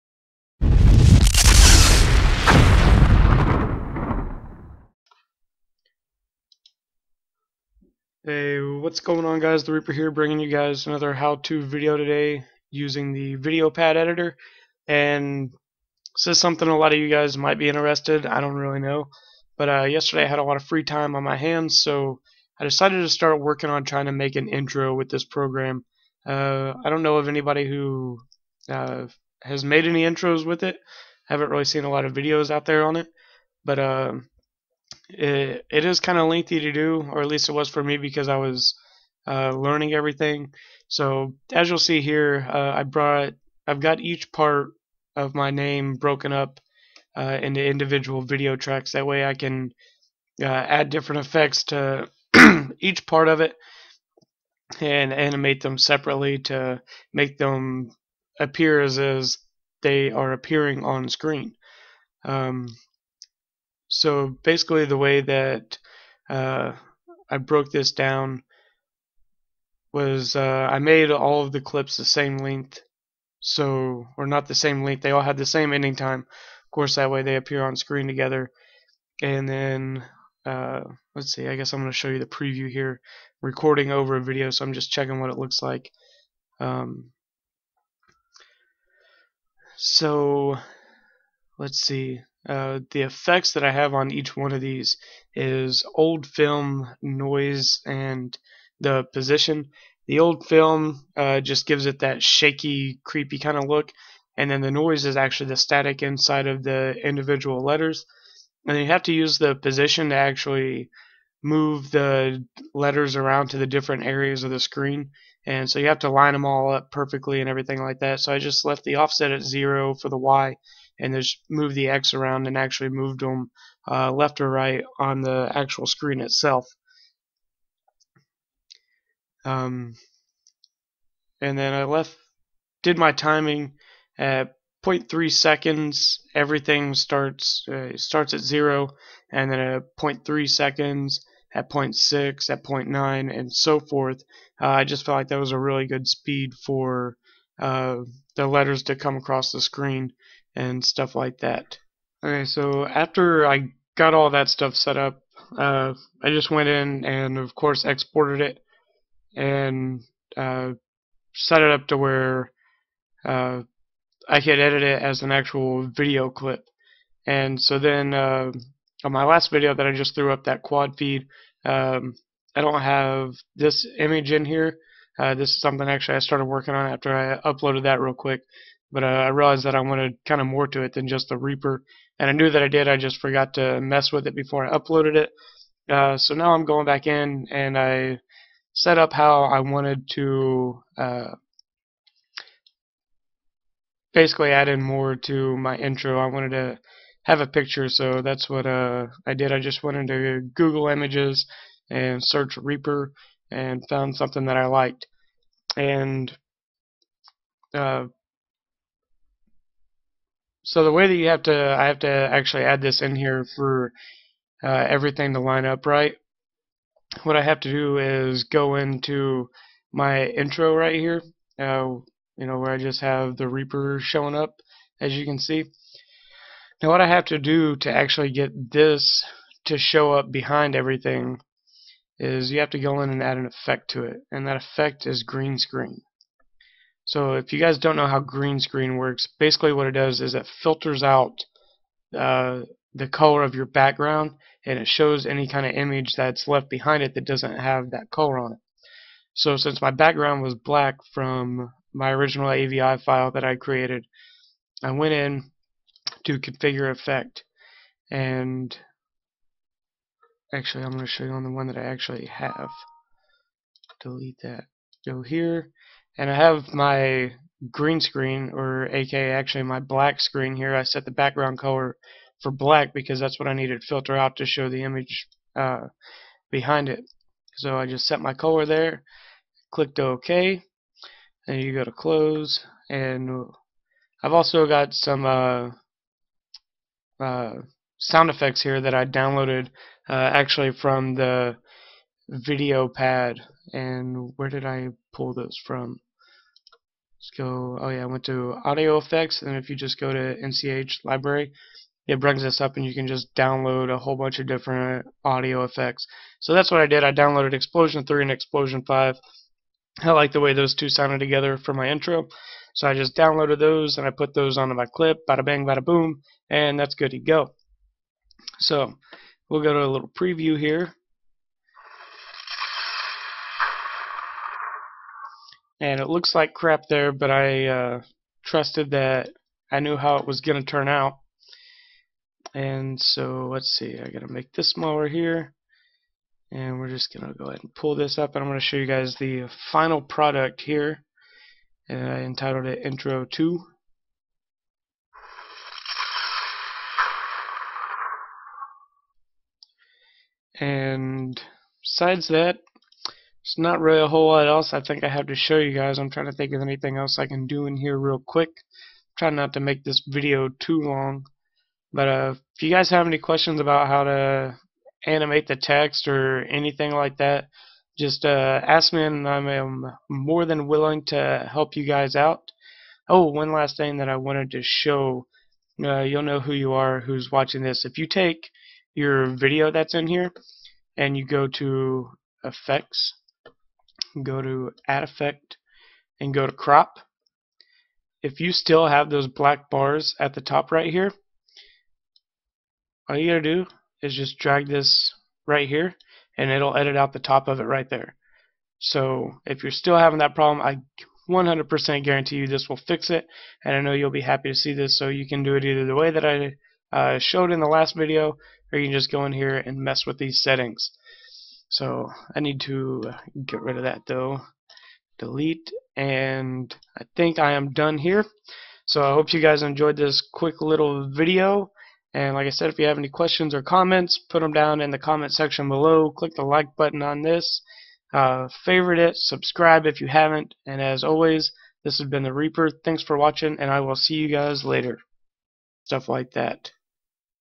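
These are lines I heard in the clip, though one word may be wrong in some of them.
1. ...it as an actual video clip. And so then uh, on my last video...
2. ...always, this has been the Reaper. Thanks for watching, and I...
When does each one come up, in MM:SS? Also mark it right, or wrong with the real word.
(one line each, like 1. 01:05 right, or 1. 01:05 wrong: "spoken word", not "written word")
1. 02:44 right
2. 07:11 right.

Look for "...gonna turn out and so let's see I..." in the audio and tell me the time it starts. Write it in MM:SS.
05:30.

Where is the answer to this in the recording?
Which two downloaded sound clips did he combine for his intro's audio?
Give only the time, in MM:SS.
05:07.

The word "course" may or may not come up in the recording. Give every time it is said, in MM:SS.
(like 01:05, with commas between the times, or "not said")
01:16, 02:37.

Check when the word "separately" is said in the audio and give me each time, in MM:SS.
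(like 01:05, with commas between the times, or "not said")
00:55.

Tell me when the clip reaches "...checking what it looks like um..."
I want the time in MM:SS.
01:24.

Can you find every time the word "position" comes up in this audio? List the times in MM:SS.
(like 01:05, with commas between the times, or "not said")
01:39, 01:49.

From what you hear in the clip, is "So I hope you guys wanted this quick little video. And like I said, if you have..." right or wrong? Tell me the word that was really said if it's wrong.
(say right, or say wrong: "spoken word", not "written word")
wrong: "enjoyed", not "wanted".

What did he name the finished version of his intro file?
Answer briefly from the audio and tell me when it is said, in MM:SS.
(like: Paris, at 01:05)
Intro 2, at 05:42.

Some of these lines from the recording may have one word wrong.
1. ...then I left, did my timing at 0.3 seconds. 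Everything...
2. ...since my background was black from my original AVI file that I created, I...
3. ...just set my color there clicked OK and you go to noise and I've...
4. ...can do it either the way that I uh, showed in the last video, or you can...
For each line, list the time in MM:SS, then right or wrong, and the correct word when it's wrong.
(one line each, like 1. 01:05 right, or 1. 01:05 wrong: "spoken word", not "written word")
1. 02:11 right
2. 04:09 right
3. 04:37 wrong: "close", not "noise"
4. 06:45 right.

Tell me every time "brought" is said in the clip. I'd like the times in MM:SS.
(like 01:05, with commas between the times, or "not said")
00:42.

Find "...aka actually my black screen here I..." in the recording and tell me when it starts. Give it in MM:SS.
04:28.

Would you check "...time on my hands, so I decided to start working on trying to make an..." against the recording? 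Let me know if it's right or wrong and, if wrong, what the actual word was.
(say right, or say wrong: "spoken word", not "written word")
right.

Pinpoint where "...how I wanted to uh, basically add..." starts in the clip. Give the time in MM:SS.
03:09.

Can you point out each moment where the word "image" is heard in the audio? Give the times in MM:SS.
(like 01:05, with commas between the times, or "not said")
02:53, 03:20, 04:05, 04:34.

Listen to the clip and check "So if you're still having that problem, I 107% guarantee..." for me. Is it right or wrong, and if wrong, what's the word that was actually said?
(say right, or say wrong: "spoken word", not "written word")
wrong: "100", not "107".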